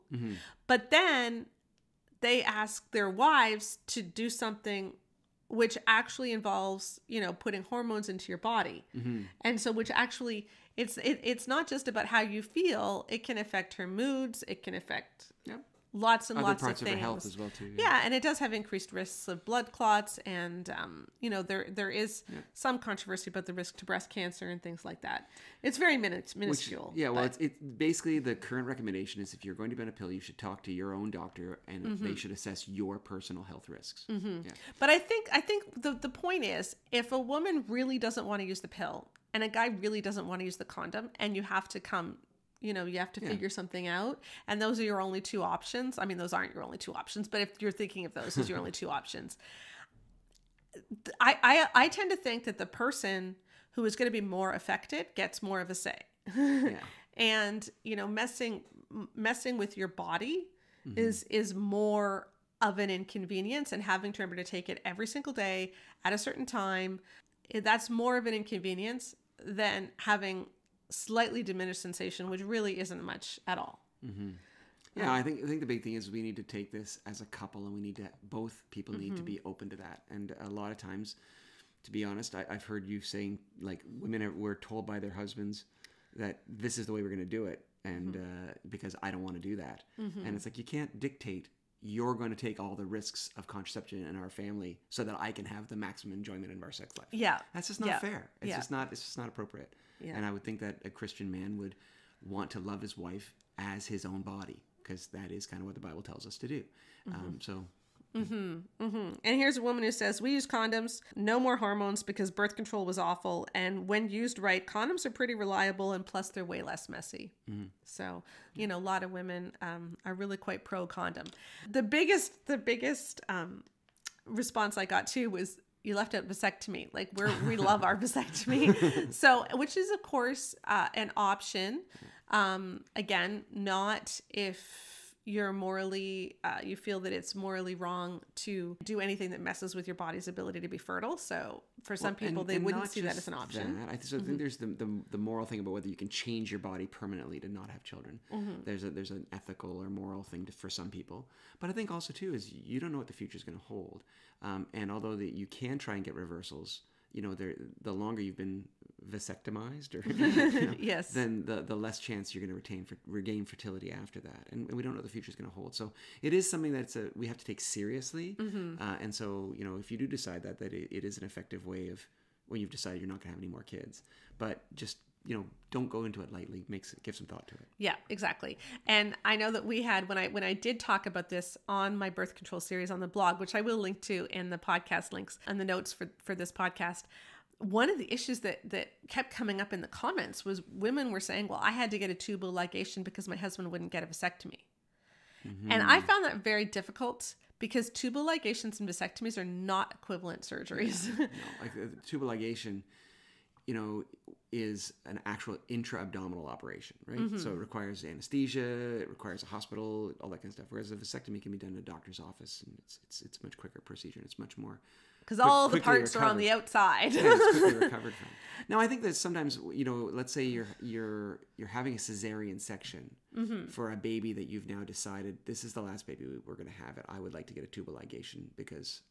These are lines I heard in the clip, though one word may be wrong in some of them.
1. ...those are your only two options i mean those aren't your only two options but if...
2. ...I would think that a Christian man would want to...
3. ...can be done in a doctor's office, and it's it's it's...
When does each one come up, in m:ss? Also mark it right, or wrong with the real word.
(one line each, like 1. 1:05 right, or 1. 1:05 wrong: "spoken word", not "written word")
1. 0:44 right
2. 1:40 right
3. 3:31 right.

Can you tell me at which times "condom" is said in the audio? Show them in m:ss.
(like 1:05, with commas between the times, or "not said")
0:40, 1:50, 1:54, 2:00.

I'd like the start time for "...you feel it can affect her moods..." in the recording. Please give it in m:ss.
0:12.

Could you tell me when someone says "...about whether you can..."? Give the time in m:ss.
2:25.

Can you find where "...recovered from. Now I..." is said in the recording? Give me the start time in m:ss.
3:37.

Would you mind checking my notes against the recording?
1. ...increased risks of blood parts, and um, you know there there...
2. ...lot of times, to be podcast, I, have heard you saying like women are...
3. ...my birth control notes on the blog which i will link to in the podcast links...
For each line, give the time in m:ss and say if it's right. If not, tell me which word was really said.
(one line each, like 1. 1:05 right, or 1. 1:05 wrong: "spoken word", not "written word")
1. 0:18 wrong: "clots", not "parts"
2. 1:20 wrong: "honest", not "podcast"
3. 3:01 wrong: "series", not "notes".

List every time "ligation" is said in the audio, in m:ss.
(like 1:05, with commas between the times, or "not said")
3:12, 3:18, 3:22, 3:47.